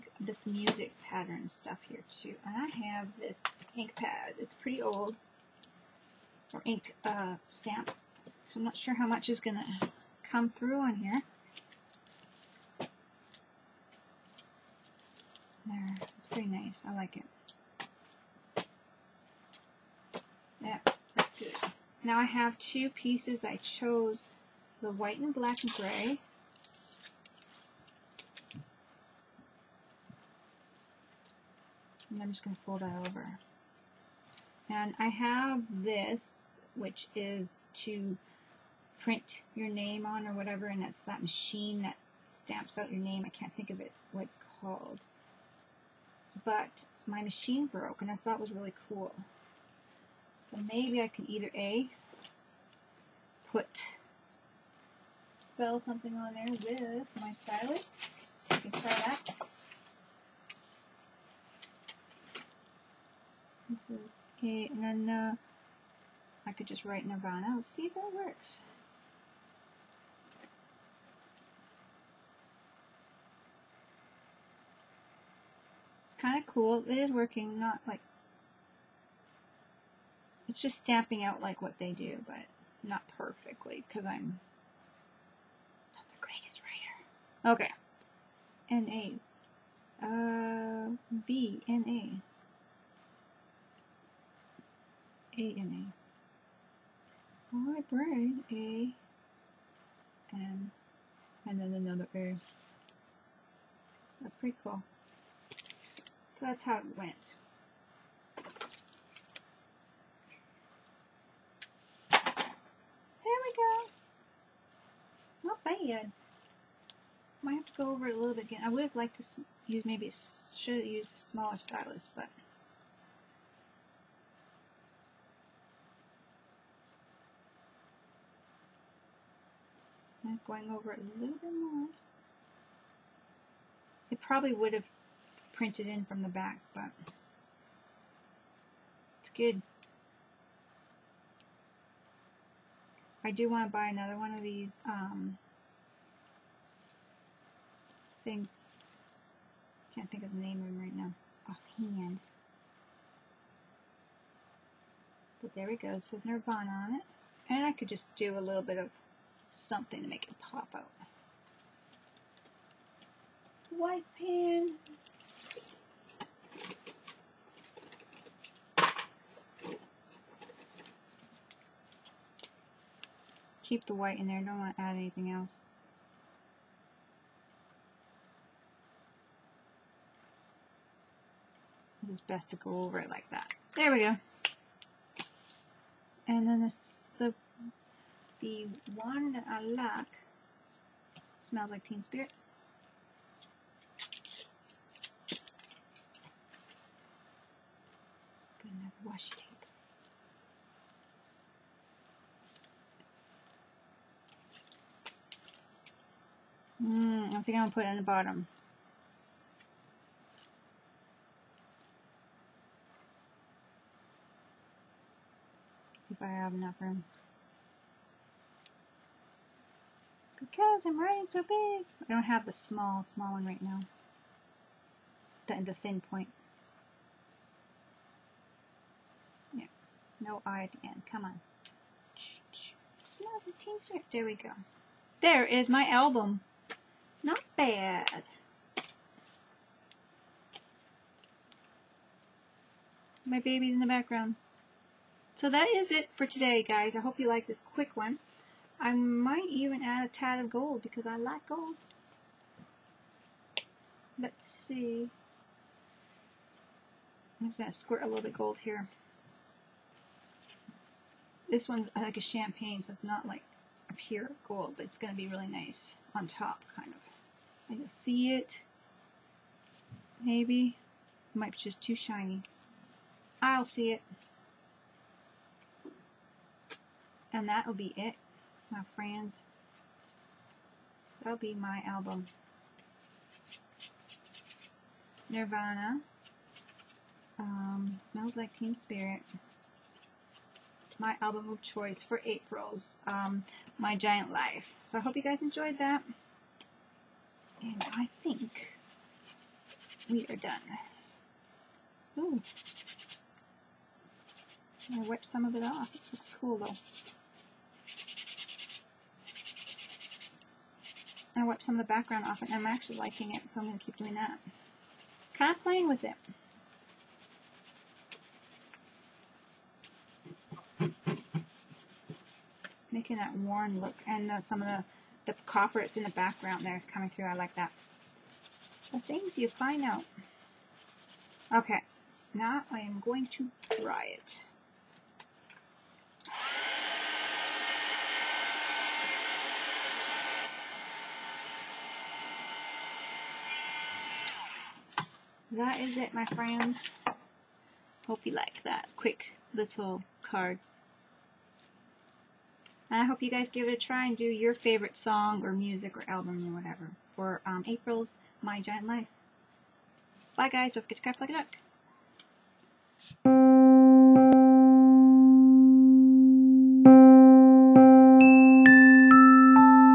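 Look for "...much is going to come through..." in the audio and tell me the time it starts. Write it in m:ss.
0:09.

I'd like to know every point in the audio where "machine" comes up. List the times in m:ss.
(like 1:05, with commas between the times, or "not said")
0:41, 0:47.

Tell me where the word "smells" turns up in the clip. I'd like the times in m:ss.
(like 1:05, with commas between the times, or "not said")
3:11, 3:53, 4:48.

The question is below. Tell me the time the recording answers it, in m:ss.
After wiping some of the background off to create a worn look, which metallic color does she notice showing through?
5:25.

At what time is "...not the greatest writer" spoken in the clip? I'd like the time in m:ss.
1:25.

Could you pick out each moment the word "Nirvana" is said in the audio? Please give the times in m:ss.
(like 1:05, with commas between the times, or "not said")
1:07, 2:36, 4:45.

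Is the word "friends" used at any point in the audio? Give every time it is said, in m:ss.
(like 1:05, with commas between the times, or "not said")
4:38, 5:46.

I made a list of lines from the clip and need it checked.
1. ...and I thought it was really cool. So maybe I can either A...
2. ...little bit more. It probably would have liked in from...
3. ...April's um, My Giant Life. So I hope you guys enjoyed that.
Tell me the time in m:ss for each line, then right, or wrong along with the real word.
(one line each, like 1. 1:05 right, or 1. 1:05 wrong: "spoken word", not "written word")
1. 0:48 right
2. 2:11 wrong: "printed", not "liked"
3. 4:52 right.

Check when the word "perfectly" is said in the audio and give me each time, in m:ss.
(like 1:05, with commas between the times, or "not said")
1:23.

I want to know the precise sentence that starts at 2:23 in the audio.
I do want to buy another one of these um, things.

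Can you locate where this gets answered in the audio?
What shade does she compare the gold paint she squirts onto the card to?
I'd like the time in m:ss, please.
4:22.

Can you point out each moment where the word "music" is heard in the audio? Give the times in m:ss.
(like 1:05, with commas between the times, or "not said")
0:00, 5:55.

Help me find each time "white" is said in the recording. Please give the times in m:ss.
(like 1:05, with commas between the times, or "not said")
0:24, 2:43, 2:53.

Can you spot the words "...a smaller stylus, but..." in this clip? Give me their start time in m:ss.
2:01.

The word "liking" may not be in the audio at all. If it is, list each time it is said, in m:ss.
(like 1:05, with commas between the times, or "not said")
5:12.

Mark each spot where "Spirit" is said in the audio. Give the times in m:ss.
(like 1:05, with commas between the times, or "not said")
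3:12, 4:48.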